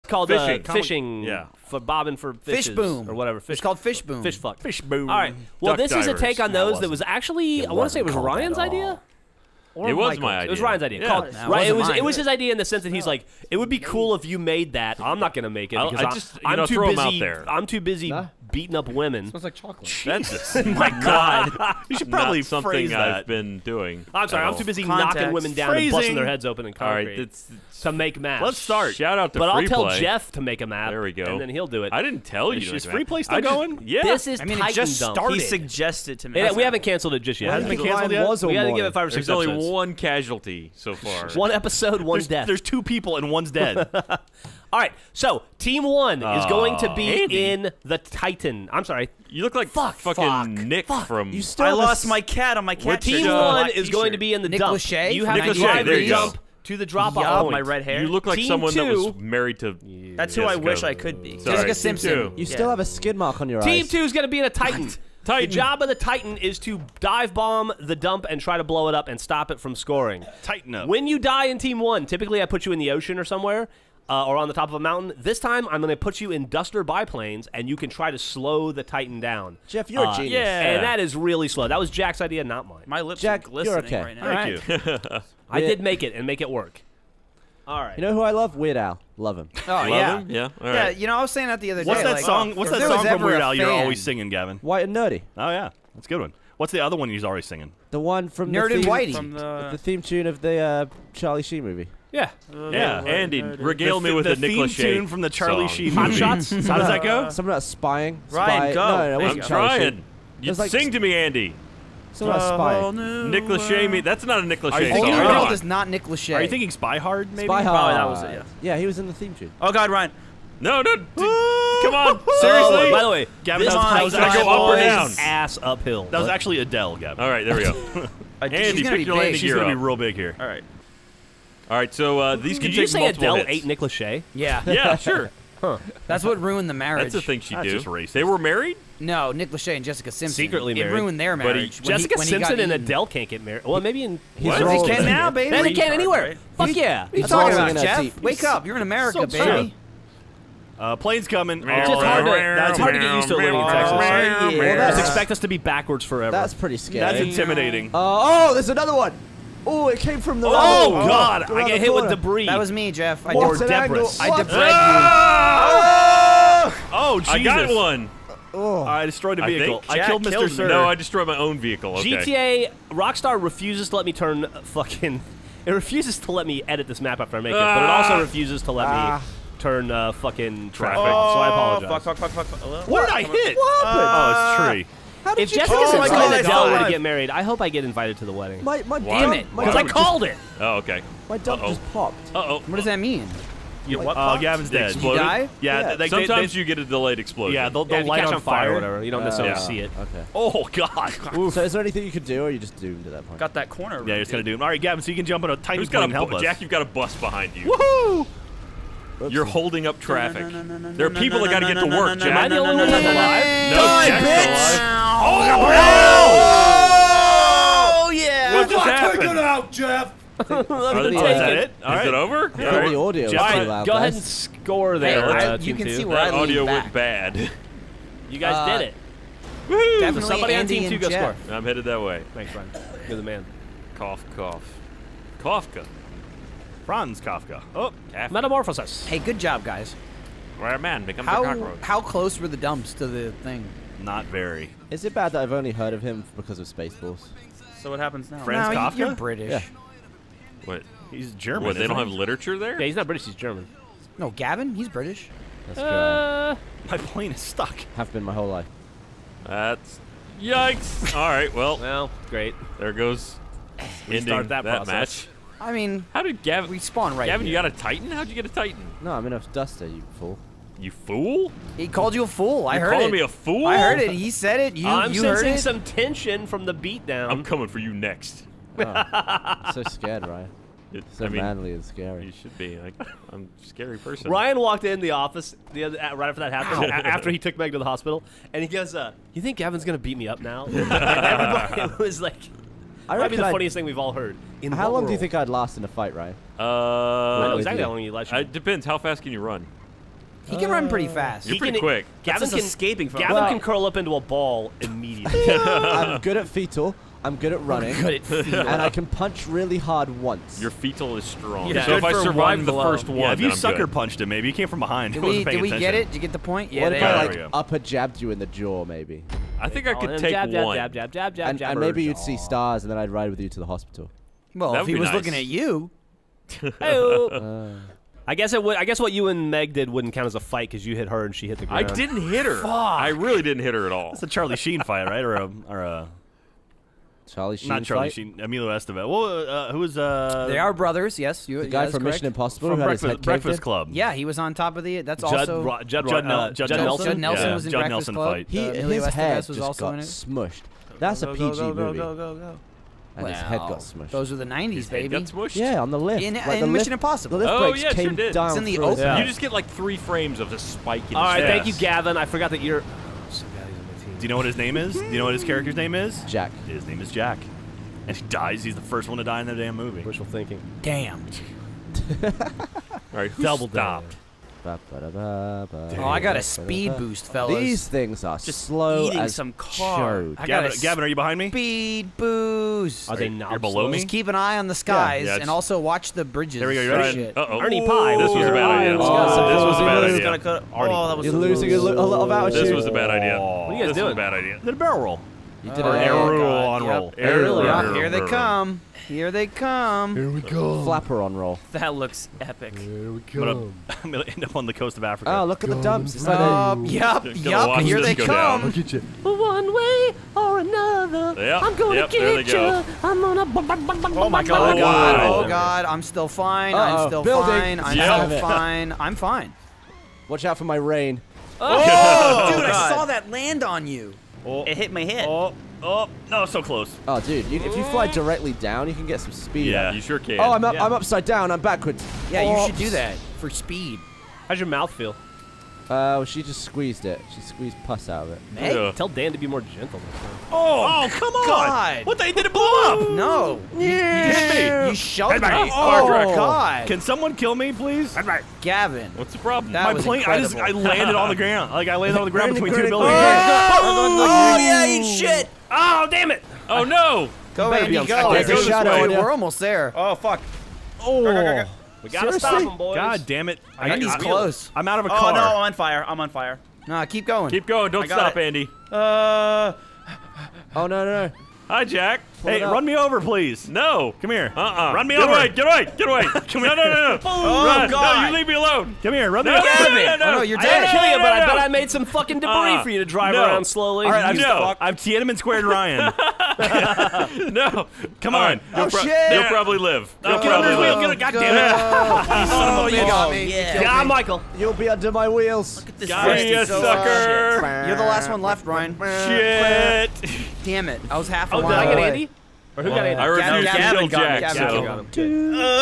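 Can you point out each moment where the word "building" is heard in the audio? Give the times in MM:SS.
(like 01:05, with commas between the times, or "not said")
06:57, 07:32.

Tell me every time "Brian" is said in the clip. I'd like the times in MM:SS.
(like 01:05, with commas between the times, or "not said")
03:52, 08:18.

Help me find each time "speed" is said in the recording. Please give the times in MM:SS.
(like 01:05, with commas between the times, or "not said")
06:16, 06:21, 07:09, 07:13.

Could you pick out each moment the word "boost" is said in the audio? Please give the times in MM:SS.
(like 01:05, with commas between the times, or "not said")
06:16, 06:22.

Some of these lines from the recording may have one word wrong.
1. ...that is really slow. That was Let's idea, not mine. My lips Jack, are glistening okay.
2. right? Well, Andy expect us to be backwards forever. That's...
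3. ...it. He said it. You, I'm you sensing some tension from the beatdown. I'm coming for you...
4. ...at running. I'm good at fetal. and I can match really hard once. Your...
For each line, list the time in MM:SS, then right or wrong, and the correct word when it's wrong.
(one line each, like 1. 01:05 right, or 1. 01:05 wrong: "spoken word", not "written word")
1. 01:20 wrong: "Jack", not "Let"
2. 02:33 wrong: "Just", not "Andy"
3. 04:33 right
4. 05:07 wrong: "punch", not "match".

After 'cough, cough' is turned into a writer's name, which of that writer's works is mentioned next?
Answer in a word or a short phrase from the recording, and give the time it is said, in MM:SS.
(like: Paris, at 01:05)
Metamorphosis, at 03:58.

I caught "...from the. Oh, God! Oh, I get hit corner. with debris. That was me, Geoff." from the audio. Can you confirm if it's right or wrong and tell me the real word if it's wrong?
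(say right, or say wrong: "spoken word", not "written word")
right.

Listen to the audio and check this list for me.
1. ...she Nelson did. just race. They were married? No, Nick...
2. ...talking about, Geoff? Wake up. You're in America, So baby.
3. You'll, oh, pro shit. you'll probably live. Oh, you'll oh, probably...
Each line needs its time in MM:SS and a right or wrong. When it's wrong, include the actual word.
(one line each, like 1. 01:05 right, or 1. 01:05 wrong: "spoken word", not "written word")
1. 02:17 wrong: "Not", not "Nelson"
2. 02:27 right
3. 08:08 right.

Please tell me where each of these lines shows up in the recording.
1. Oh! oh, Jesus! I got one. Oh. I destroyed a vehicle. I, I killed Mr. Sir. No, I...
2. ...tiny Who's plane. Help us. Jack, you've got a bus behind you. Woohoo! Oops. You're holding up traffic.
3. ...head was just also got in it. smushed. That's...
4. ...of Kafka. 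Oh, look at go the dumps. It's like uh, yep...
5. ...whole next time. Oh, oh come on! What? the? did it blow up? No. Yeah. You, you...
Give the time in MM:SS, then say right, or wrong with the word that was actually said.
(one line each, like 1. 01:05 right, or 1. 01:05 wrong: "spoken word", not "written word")
1. 02:46 right
2. 03:25 right
3. 05:49 right
4. 06:44 wrong: "Africa", not "Kafka"
5. 07:19 wrong: "gentle", not "whole".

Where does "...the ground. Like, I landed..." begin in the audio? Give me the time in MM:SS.
07:31.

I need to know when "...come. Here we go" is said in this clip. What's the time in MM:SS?
06:39.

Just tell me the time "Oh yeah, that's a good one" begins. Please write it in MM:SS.
01:35.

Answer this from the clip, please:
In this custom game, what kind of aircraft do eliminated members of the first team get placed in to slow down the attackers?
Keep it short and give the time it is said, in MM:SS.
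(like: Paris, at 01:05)
duster biplanes, at 01:16.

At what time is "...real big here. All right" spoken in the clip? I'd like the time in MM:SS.
02:09.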